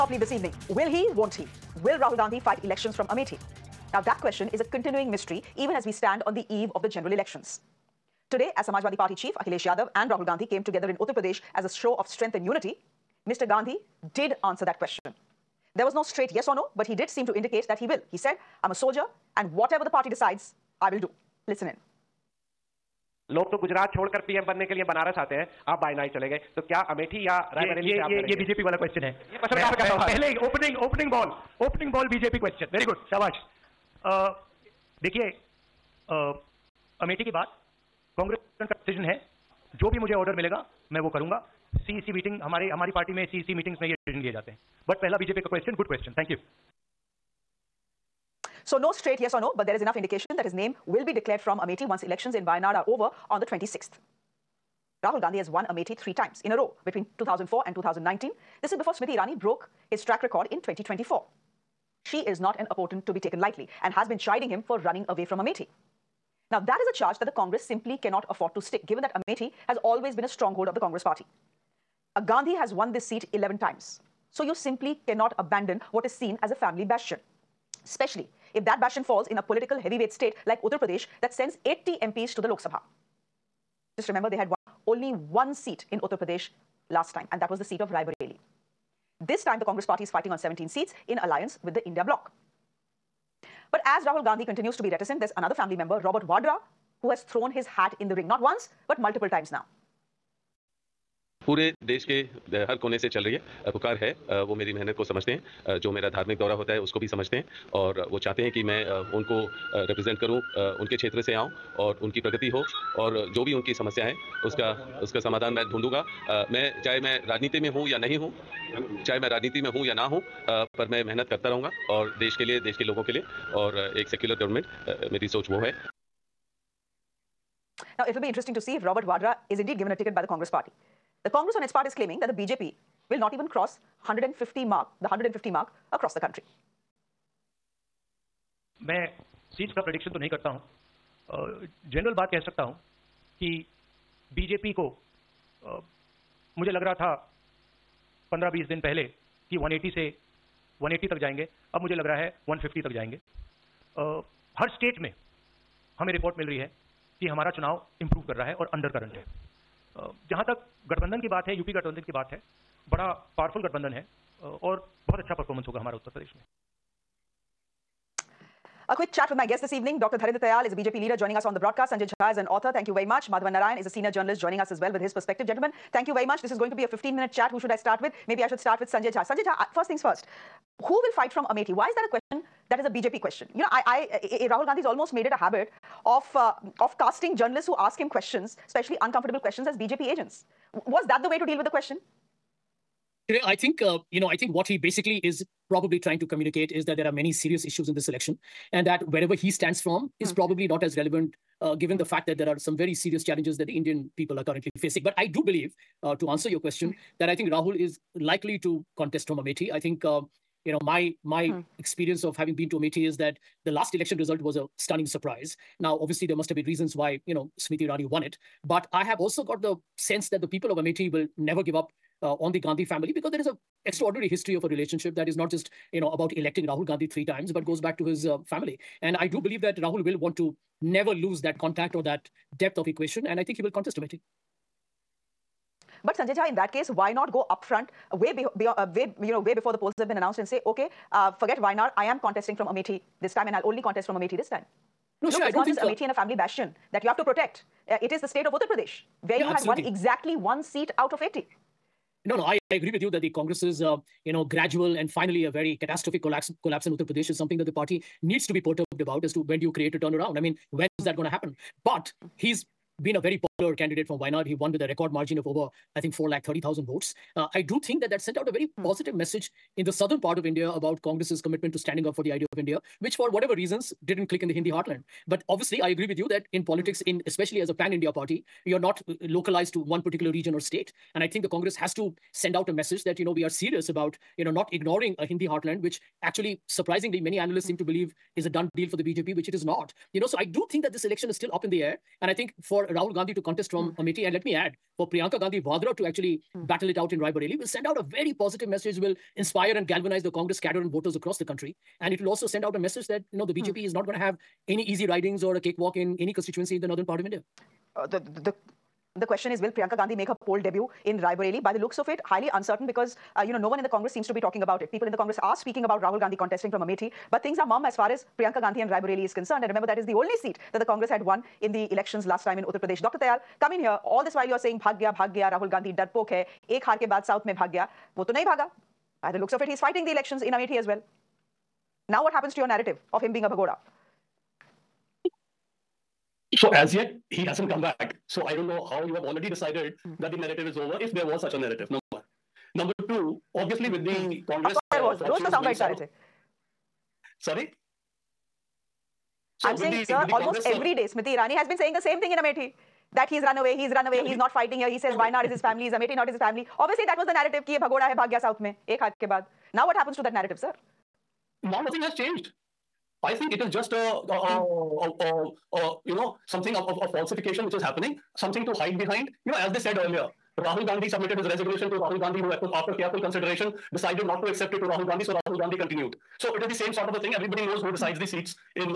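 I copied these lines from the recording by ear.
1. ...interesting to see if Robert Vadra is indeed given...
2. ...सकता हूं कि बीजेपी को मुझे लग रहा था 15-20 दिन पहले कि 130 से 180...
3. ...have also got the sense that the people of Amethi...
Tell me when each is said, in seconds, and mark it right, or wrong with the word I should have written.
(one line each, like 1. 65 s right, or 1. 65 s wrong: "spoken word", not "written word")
1. 128 s right
2. 142 s wrong: "180", not "130"
3. 219 s right.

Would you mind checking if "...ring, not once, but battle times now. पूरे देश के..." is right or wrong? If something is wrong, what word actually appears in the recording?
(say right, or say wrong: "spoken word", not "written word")
wrong: "multiple", not "battle".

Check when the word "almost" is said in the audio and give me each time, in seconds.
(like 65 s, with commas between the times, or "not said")
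184 s, 350 s.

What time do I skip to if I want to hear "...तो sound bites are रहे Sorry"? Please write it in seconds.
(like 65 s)
345 s.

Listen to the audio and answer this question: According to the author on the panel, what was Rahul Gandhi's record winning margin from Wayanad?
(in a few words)
4 lakh 30,000 votes.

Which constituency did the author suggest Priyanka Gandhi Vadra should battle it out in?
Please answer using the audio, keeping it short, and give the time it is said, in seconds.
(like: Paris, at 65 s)
Rai Bareli, at 297 s.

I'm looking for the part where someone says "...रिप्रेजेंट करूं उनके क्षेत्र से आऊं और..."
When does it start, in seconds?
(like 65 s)
109 s.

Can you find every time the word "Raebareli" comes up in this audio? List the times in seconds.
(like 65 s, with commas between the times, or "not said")
87 s, 311 s, 318 s.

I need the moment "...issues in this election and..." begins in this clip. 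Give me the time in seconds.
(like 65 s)
197 s.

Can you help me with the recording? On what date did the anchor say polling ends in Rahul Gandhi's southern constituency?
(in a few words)
26th.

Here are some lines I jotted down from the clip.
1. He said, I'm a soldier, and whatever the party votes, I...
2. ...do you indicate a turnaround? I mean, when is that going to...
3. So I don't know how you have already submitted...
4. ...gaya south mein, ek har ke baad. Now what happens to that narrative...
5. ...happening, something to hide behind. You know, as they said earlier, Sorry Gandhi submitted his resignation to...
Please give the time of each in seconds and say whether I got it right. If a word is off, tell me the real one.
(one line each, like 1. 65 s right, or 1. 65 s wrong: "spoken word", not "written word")
1. 18 s wrong: "decides", not "votes"
2. 259 s wrong: "create", not "indicate"
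3. 338 s wrong: "decided", not "submitted"
4. 358 s right
5. 367 s wrong: "Rahul", not "Sorry".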